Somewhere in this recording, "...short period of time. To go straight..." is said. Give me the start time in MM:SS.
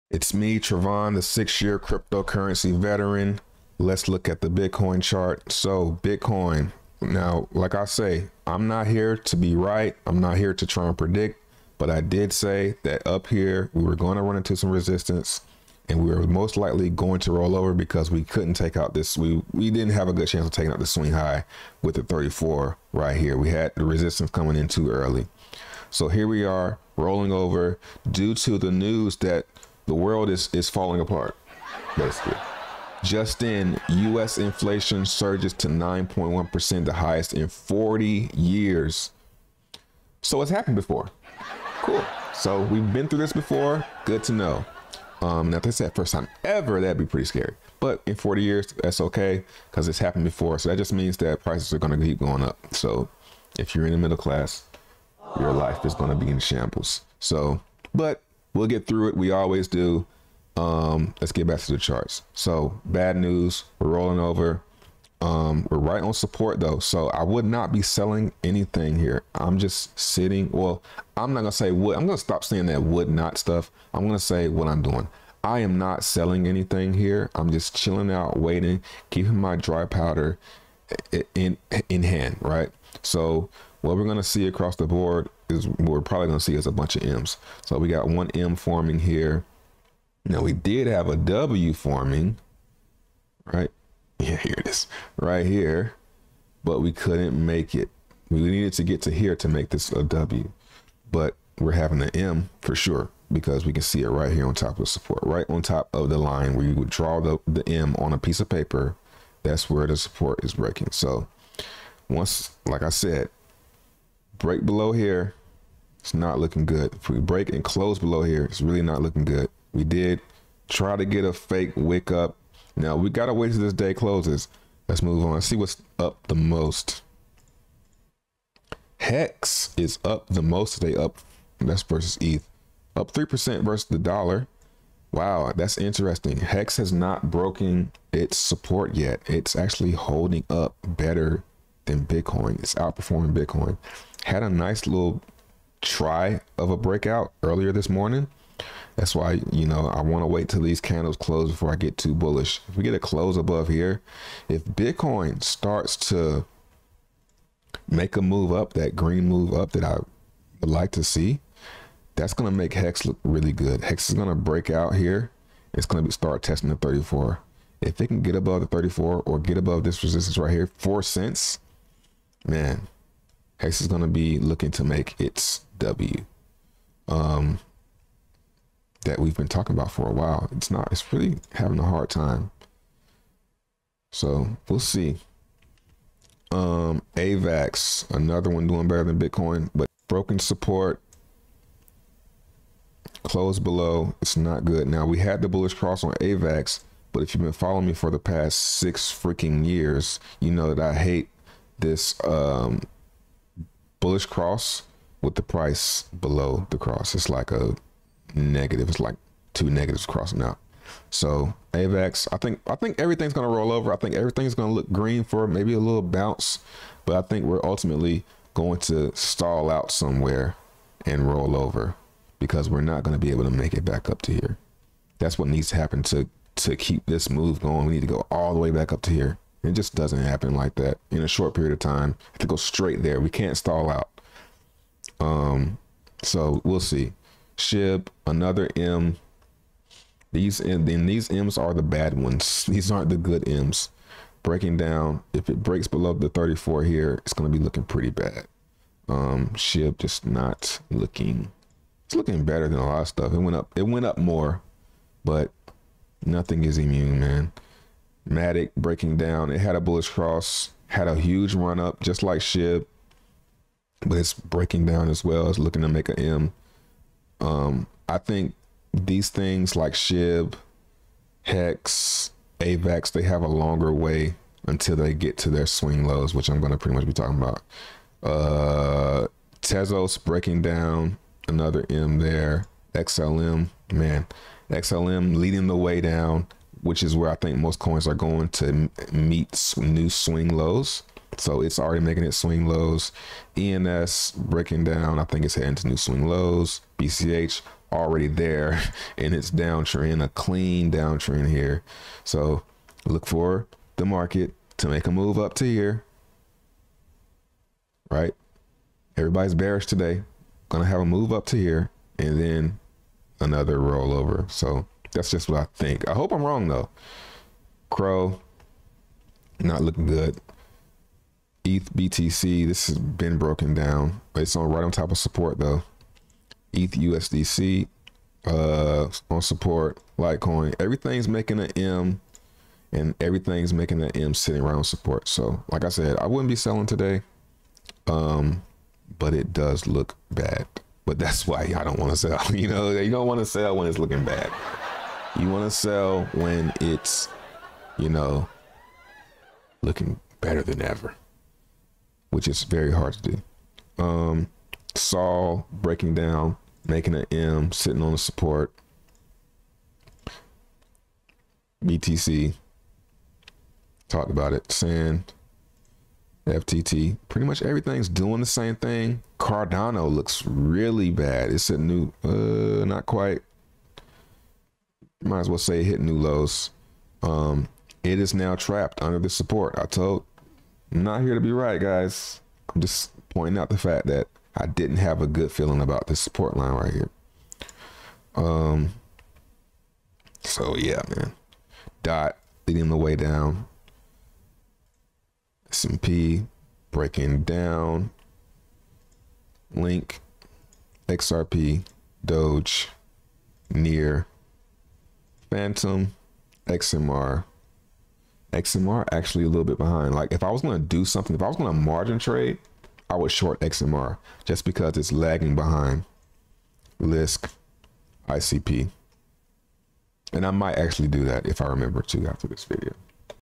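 03:51.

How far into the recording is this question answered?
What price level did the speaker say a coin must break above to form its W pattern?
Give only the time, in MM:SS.
02:50.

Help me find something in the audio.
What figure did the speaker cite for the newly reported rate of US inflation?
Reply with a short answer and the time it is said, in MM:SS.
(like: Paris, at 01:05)
9.1%, at 00:35.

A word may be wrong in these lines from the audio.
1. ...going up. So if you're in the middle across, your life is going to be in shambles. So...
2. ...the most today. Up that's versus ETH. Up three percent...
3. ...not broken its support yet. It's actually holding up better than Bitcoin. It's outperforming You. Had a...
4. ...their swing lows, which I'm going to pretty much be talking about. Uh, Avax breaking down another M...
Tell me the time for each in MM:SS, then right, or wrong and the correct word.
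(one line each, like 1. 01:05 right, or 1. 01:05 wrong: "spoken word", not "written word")
1. 00:52 wrong: "class", not "across"
2. 02:10 right
3. 02:16 wrong: "Bitcoin", not "You"
4. 04:35 wrong: "Tezos", not "Avax".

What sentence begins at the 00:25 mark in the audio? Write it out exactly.
So here we are rolling over due to the news that the world is, is falling apart, basically.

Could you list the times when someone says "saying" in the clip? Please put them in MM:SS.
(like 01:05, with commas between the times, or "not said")
01:12.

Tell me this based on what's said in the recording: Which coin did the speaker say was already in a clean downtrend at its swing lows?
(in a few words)
BCH.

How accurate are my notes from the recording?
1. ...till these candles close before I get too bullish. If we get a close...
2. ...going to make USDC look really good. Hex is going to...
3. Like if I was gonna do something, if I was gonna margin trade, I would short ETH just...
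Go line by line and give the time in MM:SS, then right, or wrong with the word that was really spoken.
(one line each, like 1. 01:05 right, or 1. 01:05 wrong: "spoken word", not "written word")
1. 02:30 right
2. 02:42 wrong: "Hex", not "USDC"
3. 06:50 wrong: "XMR", not "ETH".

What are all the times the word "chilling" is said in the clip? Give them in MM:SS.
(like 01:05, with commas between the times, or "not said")
01:17.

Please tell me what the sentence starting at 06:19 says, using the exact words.
I told not here to be right, guys.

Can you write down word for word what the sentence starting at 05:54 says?
Um, Sol breaking down, making an M, sitting on the support.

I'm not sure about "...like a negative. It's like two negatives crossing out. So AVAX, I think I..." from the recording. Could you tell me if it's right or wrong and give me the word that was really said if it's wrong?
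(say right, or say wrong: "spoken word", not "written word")
right.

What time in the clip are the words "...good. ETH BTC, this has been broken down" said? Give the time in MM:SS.
05:20.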